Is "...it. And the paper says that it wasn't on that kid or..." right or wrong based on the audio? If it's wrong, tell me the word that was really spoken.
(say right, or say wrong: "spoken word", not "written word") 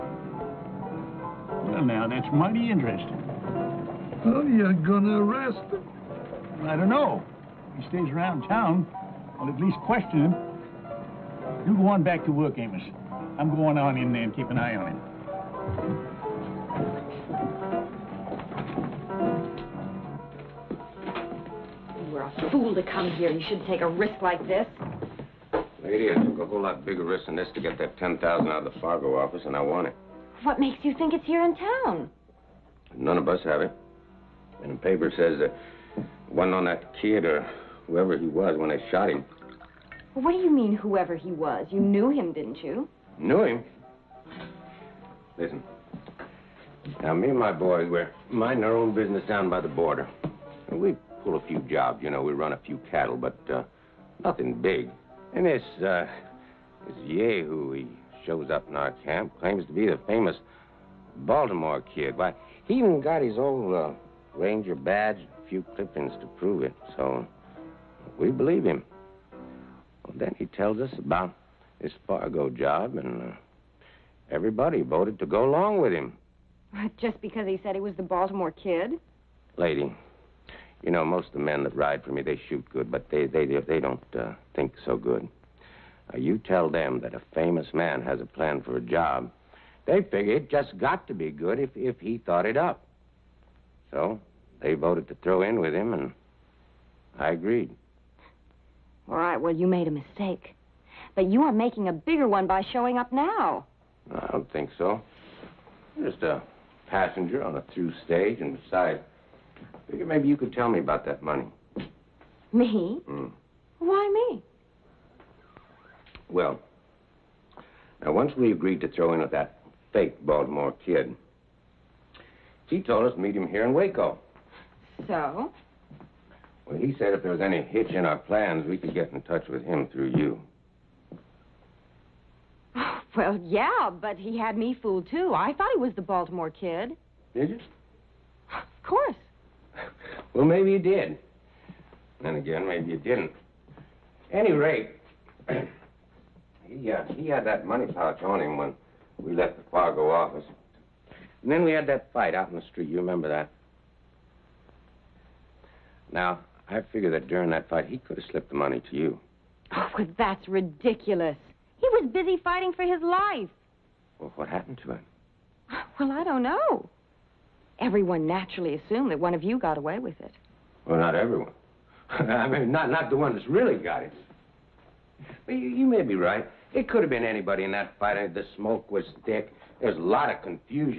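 right.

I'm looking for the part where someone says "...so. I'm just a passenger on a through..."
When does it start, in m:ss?
1:44.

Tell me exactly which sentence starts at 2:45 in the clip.
Well, I don't know everyone naturally assumed that one of you got away with it.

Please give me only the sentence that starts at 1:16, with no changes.
Just because he said he was the Baltimore kid?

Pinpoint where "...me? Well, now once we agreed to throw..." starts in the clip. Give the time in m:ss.
1:54.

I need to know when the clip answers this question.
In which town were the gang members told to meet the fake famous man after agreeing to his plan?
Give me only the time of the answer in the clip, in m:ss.
2:03.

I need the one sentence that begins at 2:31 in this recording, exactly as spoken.
And then we had that fight out in the street.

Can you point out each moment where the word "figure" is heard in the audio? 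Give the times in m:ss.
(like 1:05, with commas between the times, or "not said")
1:30, 1:49, 2:36.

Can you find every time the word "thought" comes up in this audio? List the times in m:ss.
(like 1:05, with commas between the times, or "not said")
1:32, 2:15.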